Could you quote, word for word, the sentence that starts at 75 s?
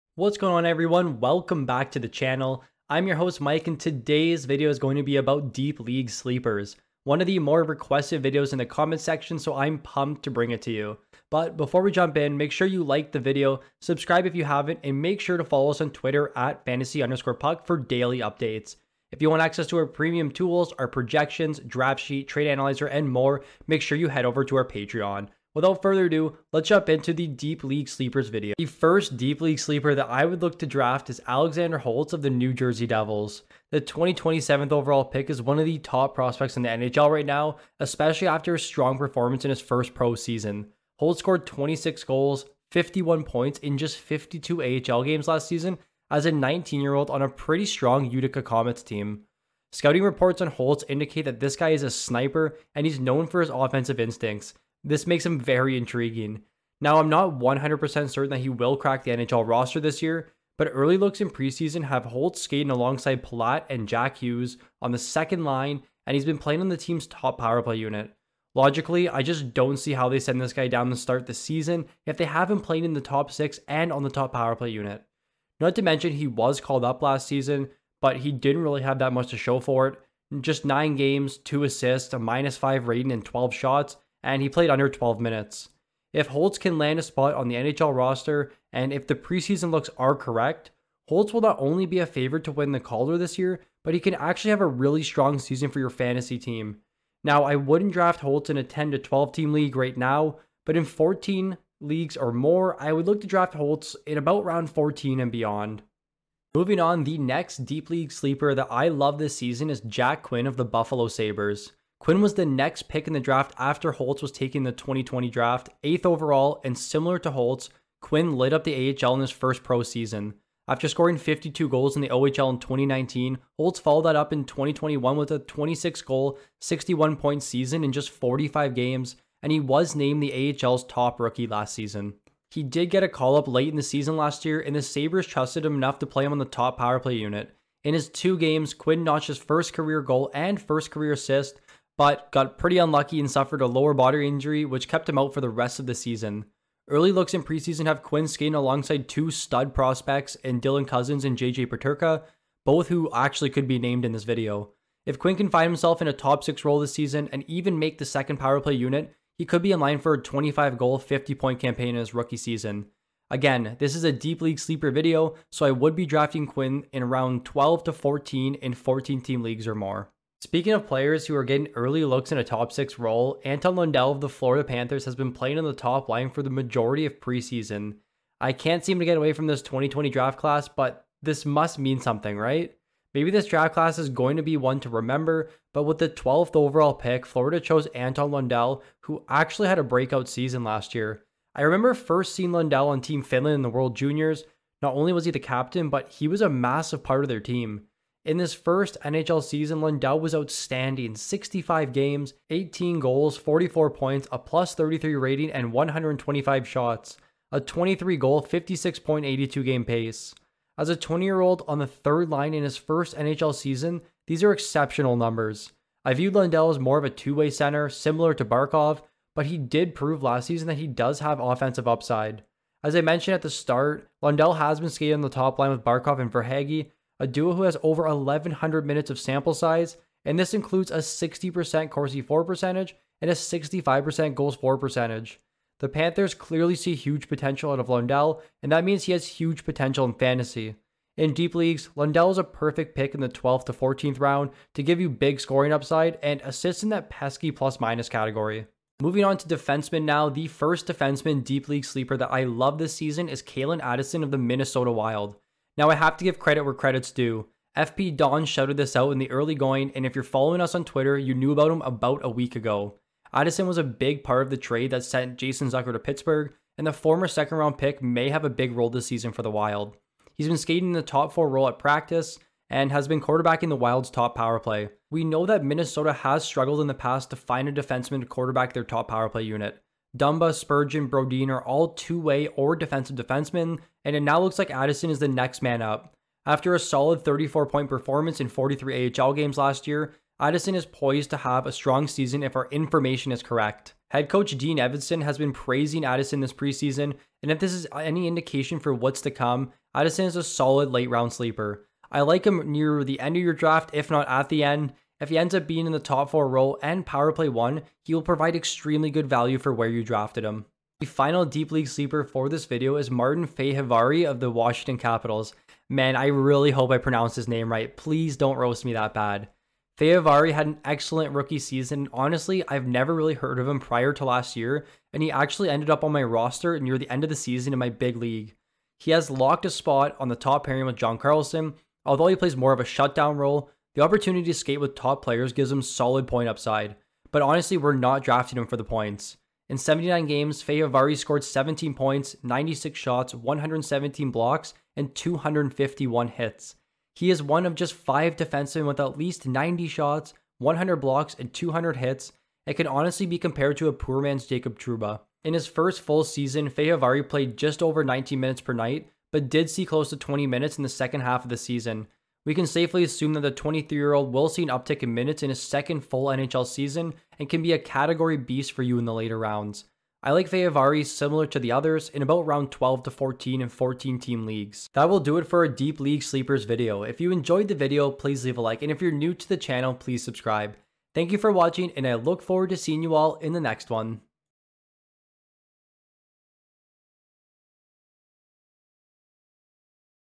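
Not to mention, he was called up last season, but he didn't really have that much to show for it.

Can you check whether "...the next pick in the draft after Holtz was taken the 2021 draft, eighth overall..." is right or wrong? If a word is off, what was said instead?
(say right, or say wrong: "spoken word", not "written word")
wrong: "2020", not "2021".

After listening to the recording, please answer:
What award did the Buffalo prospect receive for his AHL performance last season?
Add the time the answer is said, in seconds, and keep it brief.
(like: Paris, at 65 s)
AHL's top rookie, at 130 s.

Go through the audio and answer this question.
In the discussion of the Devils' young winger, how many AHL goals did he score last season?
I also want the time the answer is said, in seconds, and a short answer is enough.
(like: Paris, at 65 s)
26, at 41 s.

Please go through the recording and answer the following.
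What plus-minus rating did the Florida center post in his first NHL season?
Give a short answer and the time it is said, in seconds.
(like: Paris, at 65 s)
plus 33, at 204 s.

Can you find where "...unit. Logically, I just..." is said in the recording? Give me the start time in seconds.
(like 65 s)
67 s.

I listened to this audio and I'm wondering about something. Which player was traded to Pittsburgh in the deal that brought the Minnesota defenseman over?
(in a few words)
Jason Zucker.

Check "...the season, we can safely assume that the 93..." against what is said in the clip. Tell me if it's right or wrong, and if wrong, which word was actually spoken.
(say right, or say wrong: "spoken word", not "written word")
wrong: "23", not "93".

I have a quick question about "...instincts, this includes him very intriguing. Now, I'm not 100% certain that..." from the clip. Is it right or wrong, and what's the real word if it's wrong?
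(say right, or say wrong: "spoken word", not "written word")
wrong: "makes", not "includes".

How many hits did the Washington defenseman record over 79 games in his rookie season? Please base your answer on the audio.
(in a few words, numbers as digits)
251.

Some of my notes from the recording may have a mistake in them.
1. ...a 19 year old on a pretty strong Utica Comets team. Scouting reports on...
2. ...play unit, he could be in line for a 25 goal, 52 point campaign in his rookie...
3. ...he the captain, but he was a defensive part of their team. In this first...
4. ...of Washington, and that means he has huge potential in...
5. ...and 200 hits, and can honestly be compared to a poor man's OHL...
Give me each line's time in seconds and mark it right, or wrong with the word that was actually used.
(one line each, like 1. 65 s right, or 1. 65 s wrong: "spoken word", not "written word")
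1. 46 s right
2. 158 s wrong: "50", not "52"
3. 195 s wrong: "massive", not "defensive"
4. 237 s wrong: "Lundell", not "Washington"
5. 351 s wrong: "Jacob", not "OHL".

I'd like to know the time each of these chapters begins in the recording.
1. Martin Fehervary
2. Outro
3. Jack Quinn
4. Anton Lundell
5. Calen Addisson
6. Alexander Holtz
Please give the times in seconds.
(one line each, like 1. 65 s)
1. 311 s
2. 373 s
3. 106 s
4. 170 s
5. 248 s
6. 28 s.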